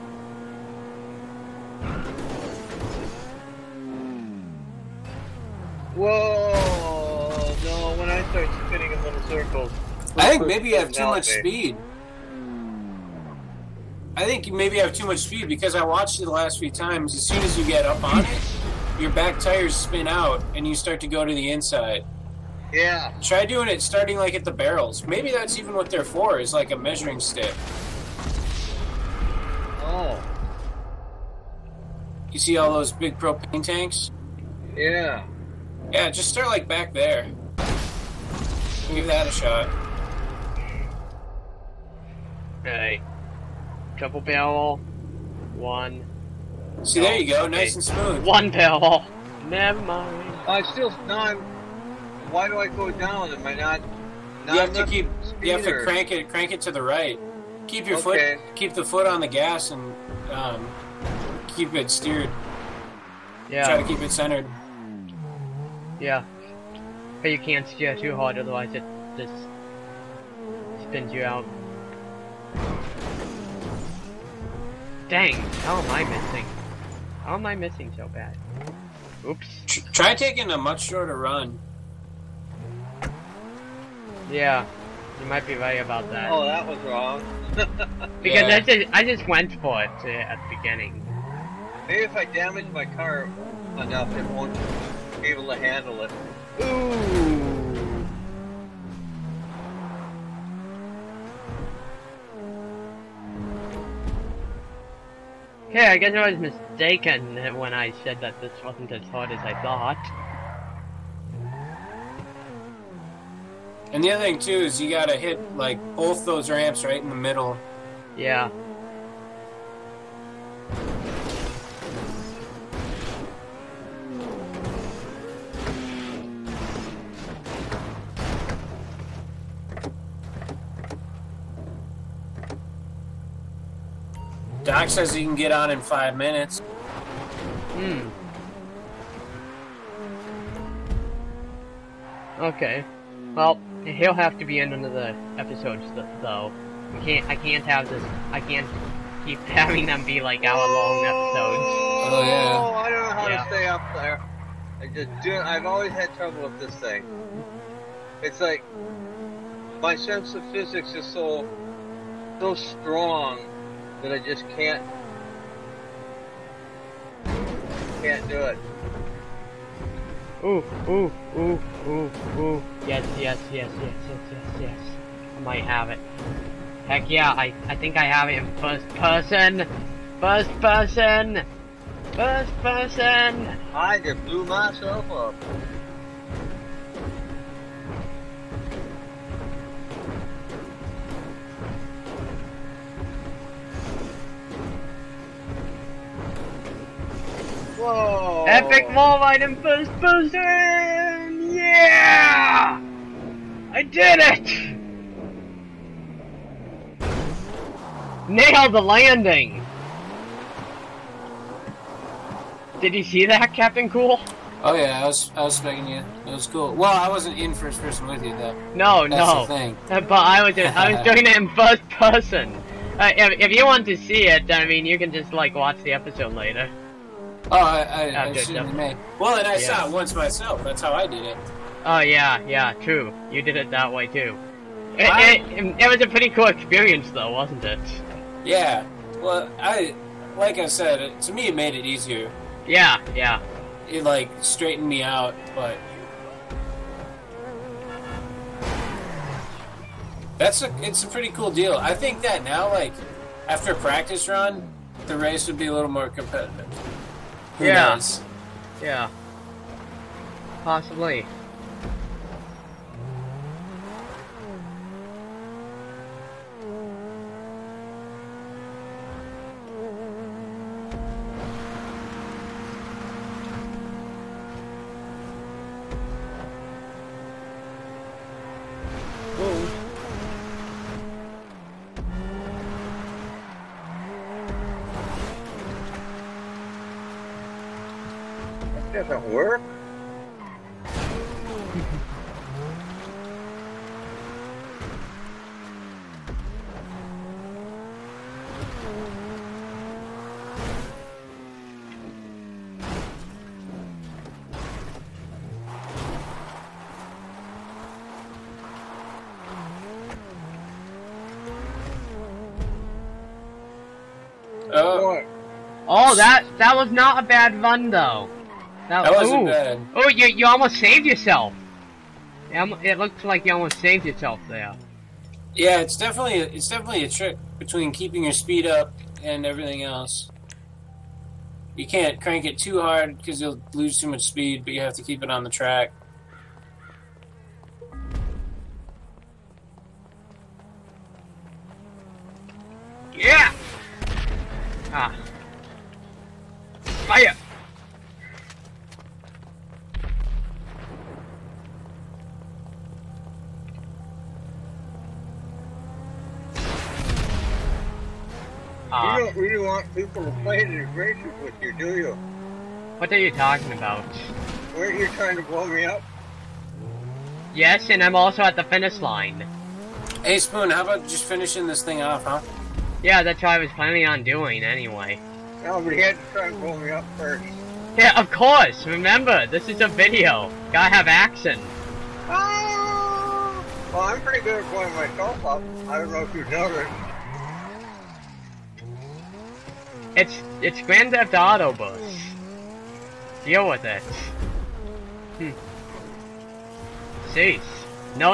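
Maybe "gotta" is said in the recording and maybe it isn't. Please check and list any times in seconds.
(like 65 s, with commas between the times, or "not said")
114 s, 380 s.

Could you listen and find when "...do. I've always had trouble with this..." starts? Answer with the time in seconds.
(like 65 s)
155 s.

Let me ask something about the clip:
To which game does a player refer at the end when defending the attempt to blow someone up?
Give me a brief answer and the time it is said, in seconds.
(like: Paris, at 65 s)
Grand Theft Auto, at 390 s.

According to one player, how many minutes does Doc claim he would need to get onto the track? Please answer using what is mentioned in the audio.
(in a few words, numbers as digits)
5.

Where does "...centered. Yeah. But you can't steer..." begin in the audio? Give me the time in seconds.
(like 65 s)
64 s.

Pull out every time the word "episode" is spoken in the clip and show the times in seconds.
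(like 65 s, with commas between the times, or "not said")
145 s, 151 s, 225 s.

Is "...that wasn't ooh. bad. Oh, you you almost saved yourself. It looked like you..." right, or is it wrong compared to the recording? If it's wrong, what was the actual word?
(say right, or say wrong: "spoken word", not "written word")
right.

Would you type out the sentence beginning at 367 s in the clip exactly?
Yes, and I'm also at the finish line.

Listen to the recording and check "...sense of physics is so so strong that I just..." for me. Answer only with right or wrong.
right.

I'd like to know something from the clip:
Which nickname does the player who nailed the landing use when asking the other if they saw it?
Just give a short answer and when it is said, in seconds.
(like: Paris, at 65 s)
Captain Cool, at 213 s.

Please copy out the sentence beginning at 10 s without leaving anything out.
I think maybe you have too much speed.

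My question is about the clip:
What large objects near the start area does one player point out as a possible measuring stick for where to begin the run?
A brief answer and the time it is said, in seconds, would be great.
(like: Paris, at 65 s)
Propane tanks, at 32 s.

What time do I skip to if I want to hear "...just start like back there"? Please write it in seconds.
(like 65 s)
36 s.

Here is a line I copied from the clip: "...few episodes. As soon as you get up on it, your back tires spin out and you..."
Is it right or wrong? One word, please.
wrong.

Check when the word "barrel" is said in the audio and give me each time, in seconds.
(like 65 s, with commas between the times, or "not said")
24 s, 44 s, 48 s.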